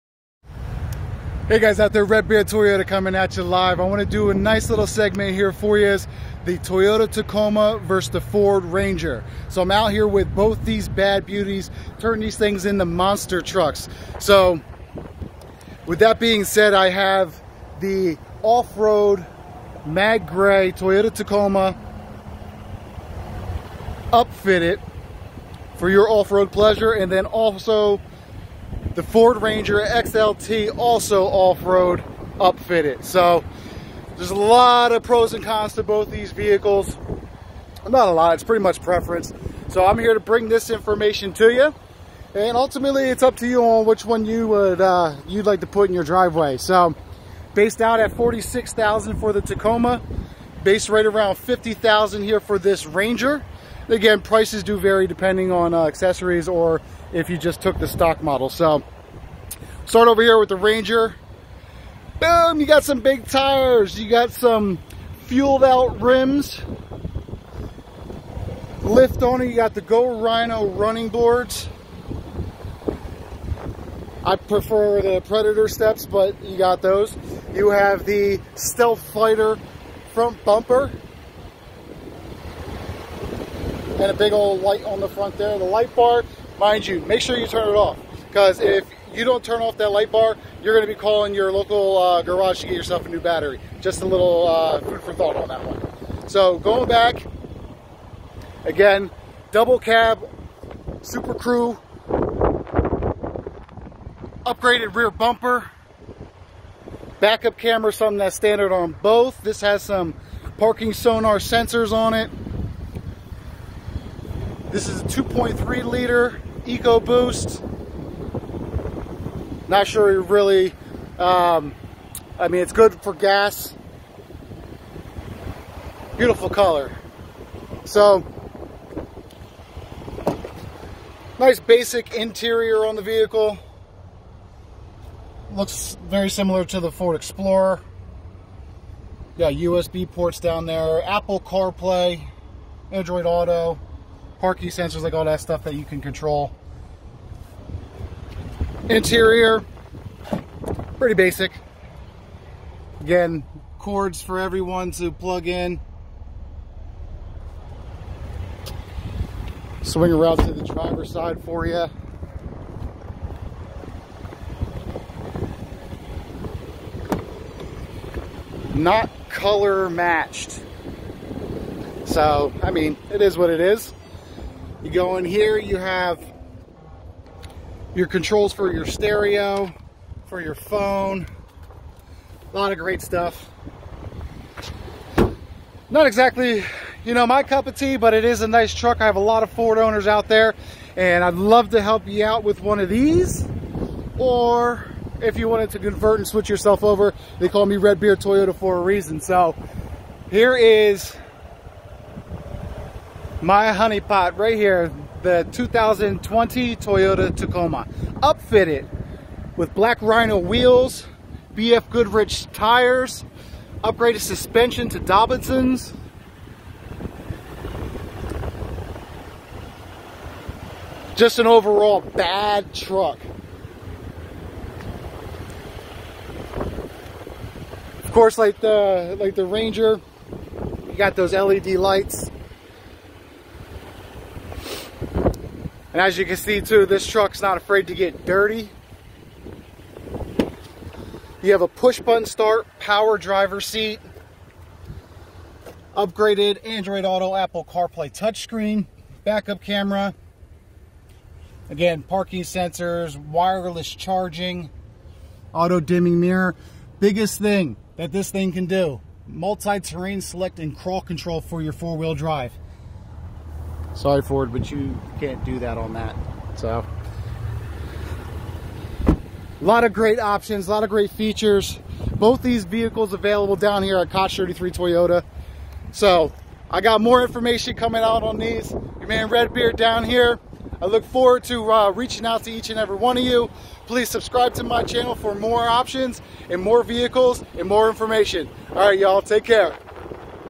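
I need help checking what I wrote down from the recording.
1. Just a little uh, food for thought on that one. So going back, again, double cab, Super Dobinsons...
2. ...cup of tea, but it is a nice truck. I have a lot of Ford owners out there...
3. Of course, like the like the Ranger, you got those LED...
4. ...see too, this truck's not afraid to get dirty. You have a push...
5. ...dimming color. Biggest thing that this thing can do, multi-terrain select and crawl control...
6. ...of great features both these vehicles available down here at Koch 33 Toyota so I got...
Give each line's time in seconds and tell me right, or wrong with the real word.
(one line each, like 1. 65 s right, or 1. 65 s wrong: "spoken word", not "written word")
1. 93 s wrong: "Crew", not "Dobinsons"
2. 187 s right
3. 228 s right
4. 236 s right
5. 255 s wrong: "mirror", not "color"
6. 270 s right.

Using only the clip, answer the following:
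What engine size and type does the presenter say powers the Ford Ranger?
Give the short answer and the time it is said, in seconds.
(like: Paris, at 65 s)
2.3 liter EcoBoost, at 115 s.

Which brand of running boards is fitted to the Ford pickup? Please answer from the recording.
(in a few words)
Go Rhino.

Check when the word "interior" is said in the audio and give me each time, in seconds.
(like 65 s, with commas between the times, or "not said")
132 s, 148 s.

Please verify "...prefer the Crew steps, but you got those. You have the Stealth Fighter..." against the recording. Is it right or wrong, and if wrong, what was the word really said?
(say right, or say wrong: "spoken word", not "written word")
wrong: "Predator", not "Crew".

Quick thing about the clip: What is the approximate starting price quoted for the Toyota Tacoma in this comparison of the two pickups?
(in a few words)
46,000.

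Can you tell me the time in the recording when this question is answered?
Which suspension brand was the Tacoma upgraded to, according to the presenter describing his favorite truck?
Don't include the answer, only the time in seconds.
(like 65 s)
214 s.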